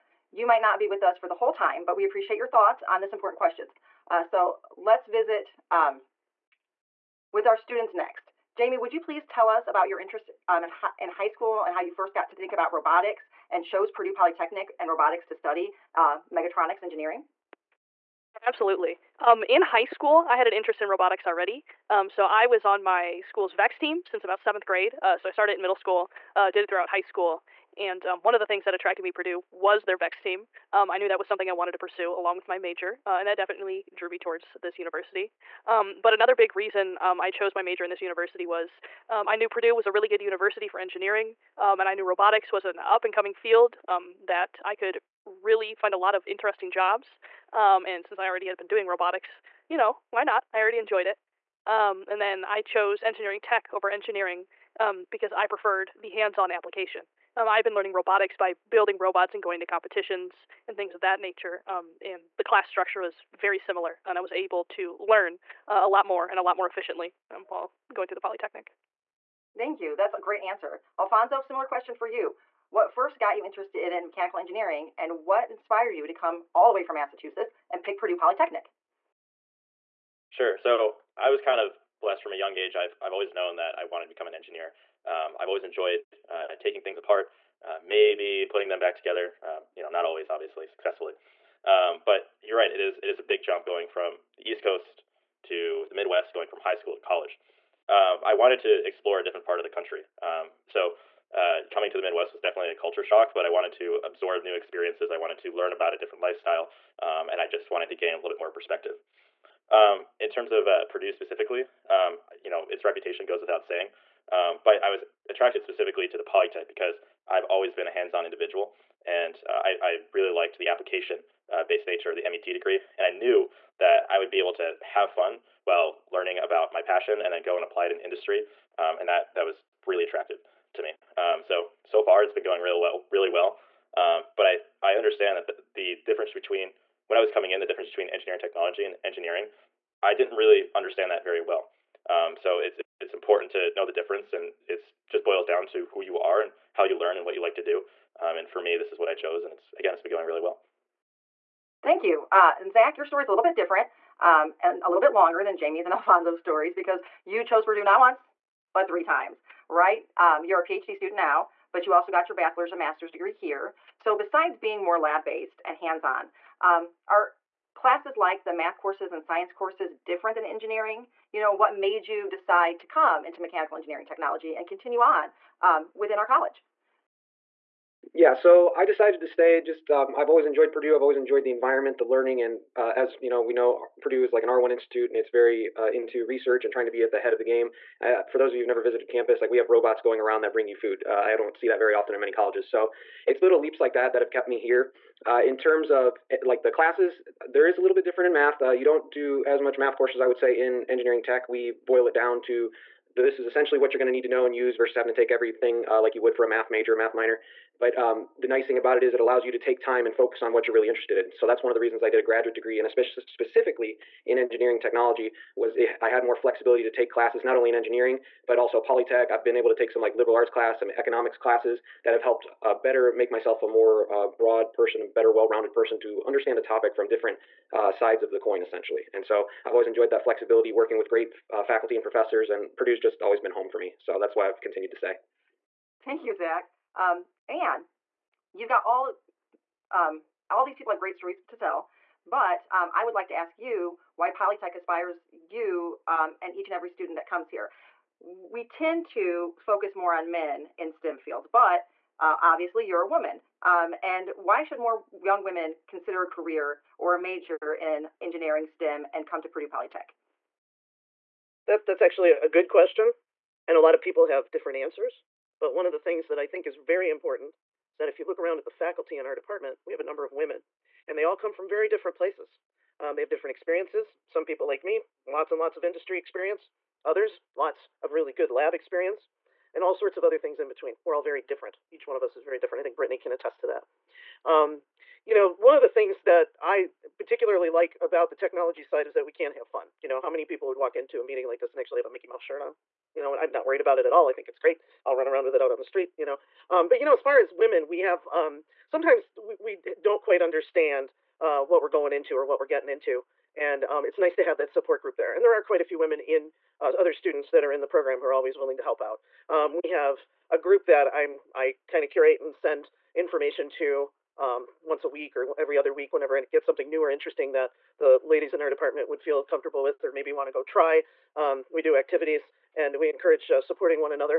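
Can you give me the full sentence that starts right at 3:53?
So that's why I've continued to stay.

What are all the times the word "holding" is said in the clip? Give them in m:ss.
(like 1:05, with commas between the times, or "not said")
not said.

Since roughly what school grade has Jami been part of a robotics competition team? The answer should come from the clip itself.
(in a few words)
7th grade.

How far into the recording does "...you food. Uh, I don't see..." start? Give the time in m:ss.
3:10.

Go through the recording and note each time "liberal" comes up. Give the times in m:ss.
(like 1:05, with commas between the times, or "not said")
3:40.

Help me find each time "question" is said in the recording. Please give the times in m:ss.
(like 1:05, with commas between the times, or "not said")
0:03, 1:11, 4:22.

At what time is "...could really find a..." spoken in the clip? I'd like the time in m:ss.
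0:44.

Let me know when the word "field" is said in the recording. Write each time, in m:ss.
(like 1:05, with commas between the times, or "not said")
0:43, 4:11.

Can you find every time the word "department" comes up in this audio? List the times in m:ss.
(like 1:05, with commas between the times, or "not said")
4:29, 5:18.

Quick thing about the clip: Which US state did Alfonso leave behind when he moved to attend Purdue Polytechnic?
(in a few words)
Massachusetts.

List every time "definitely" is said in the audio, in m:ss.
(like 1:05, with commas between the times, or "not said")
0:33, 1:42.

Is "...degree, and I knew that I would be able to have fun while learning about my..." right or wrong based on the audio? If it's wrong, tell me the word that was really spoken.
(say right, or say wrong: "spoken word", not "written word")
right.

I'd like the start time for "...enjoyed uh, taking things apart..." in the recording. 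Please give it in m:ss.
1:25.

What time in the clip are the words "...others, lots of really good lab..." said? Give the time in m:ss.
4:37.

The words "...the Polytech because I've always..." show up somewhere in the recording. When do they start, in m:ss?
1:56.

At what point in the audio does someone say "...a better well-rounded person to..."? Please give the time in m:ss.
3:45.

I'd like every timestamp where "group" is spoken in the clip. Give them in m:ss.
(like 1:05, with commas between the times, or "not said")
5:05, 5:10.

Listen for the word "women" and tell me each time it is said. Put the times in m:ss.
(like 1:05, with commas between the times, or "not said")
4:15, 4:30, 4:57, 5:05.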